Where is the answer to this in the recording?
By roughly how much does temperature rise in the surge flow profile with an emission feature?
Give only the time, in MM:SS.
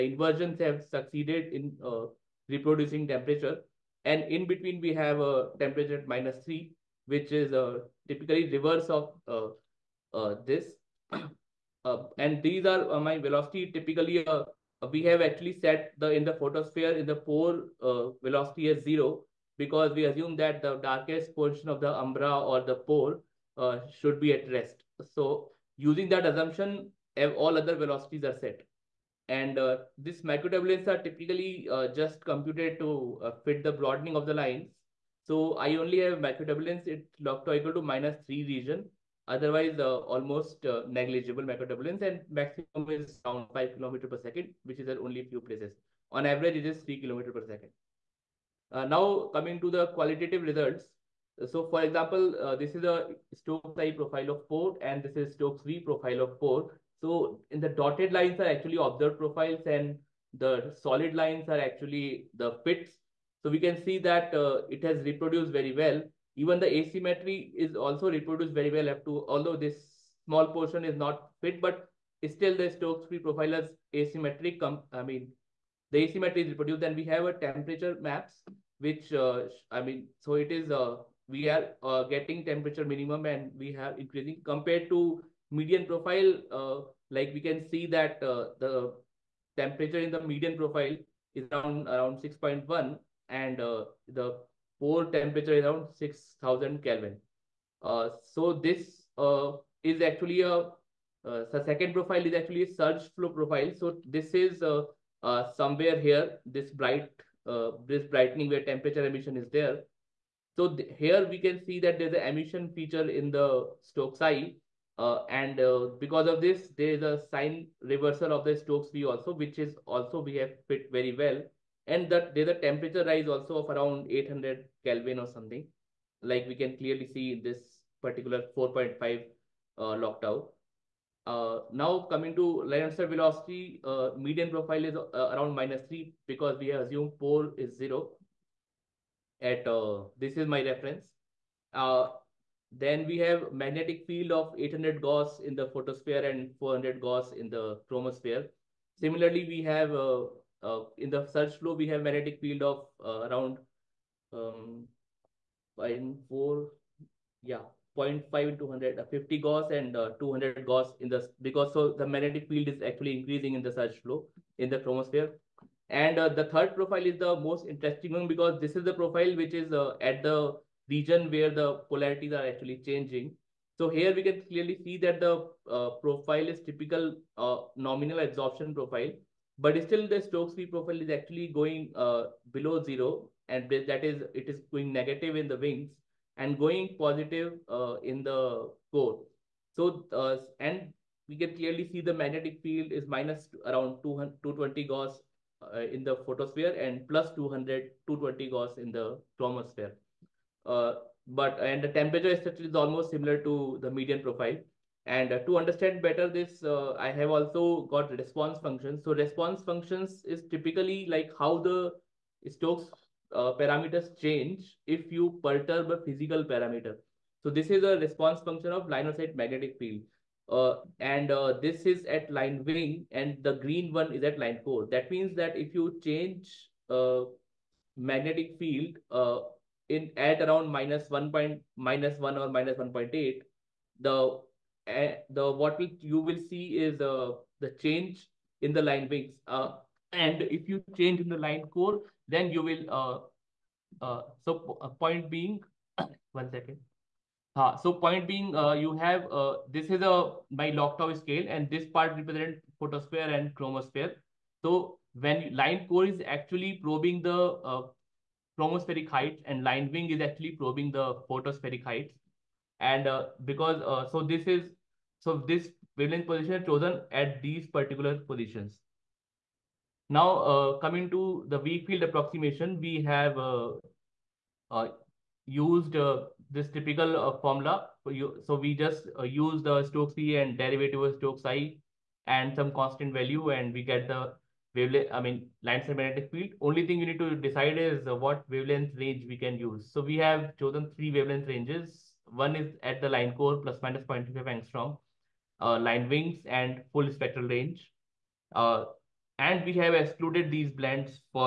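02:04.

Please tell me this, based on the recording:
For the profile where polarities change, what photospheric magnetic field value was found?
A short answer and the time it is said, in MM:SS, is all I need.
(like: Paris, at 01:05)
-220 Gauss, at 03:13.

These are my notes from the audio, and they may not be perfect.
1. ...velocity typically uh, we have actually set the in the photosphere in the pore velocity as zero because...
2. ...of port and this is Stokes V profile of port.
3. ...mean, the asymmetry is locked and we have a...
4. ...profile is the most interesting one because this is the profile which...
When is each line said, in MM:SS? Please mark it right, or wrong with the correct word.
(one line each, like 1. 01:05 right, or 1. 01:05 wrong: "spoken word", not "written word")
1. 00:13 right
2. 00:54 right
3. 01:15 wrong: "reproduced", not "locked"
4. 02:46 right.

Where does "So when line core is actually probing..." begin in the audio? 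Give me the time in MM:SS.
04:14.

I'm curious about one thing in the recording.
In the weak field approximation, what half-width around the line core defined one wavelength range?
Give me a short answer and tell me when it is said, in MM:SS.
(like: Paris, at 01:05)
0.25 angstrom, at 04:54.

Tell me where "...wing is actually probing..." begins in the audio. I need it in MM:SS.
04:19.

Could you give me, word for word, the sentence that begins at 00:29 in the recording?
And uh, these microturbulence are typically uh, just computed to uh, fit the broadening of the lines.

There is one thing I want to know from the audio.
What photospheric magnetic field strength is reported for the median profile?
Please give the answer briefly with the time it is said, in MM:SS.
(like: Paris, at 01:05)
800 Gauss, at 02:24.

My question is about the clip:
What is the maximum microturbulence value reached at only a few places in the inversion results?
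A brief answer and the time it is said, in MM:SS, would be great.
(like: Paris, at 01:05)
5 km/s, at 00:43.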